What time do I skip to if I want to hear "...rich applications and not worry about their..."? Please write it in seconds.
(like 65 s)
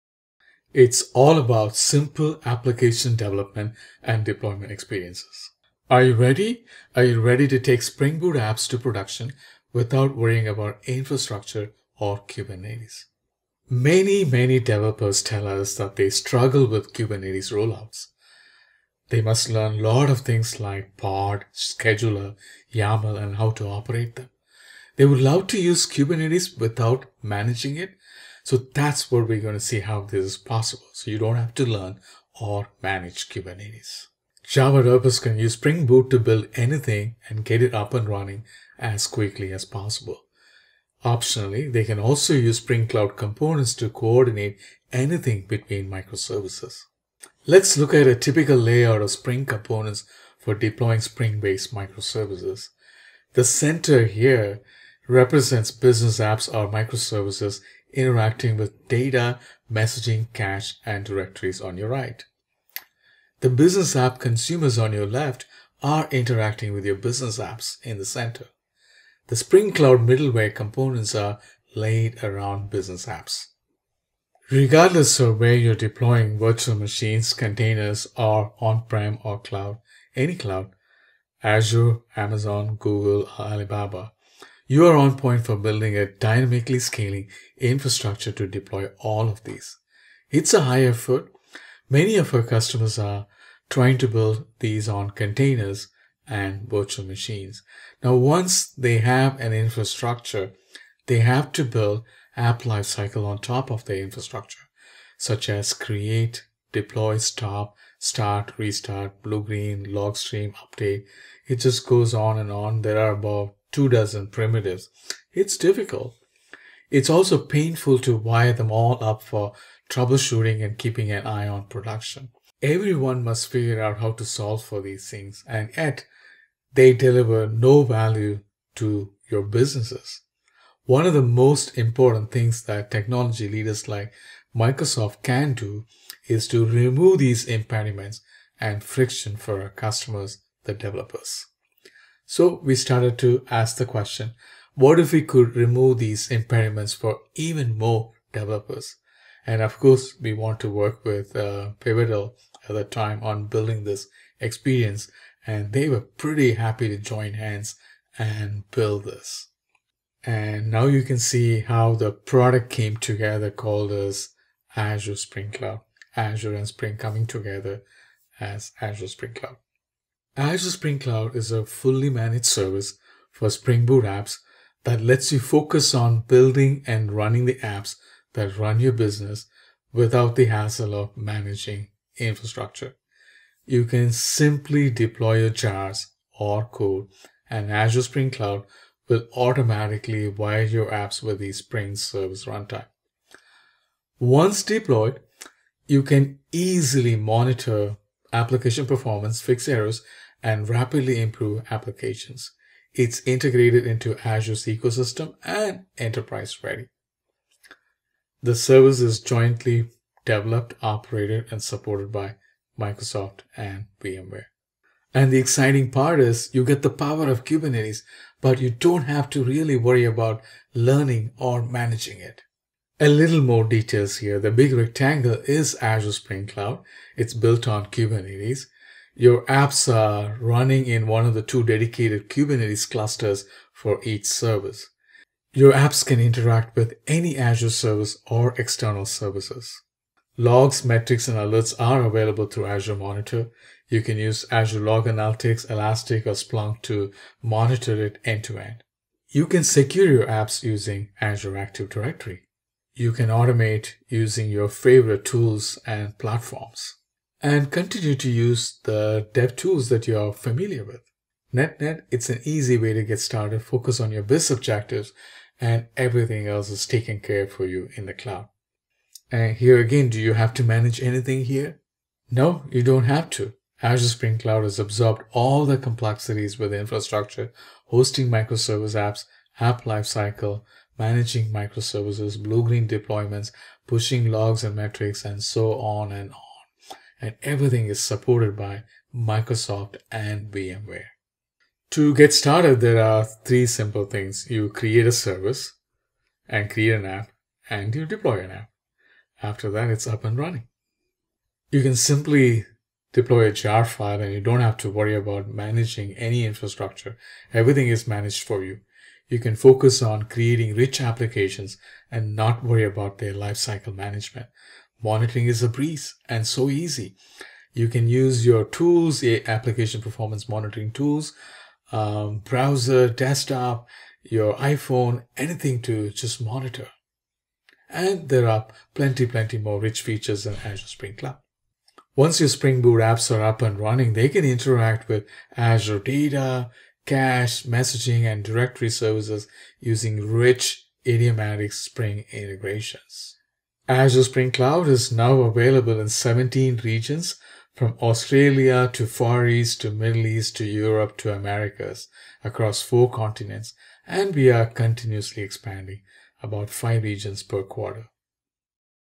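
310 s.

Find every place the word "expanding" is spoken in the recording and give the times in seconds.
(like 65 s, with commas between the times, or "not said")
355 s.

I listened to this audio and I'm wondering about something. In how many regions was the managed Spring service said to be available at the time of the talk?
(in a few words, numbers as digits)
17.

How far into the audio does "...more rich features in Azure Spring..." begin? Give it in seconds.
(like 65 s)
329 s.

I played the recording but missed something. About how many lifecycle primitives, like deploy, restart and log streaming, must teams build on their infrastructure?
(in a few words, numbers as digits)
2 dozen.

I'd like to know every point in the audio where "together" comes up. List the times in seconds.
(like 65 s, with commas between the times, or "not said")
162 s, 167 s.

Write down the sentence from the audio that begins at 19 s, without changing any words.
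They must learn a lot of things like pod, scheduler, YAML, and how to operate them.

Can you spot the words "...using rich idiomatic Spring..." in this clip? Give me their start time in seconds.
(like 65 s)
339 s.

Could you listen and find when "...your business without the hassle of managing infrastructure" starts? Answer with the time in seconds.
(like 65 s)
178 s.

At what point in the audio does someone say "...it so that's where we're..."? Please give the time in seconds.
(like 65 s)
27 s.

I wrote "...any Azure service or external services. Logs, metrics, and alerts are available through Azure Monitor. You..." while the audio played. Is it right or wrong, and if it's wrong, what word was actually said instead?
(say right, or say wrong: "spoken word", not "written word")
right.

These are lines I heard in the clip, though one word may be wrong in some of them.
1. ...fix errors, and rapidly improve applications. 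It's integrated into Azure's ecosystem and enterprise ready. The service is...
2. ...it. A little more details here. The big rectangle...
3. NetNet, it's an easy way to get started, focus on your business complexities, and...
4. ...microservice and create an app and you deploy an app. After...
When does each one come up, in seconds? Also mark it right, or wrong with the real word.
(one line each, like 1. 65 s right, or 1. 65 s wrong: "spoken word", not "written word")
1. 199 s right
2. 222 s right
3. 261 s wrong: "objectives", not "complexities"
4. 295 s wrong: "service", not "microservice".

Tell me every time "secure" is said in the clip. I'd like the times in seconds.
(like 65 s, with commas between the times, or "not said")
249 s.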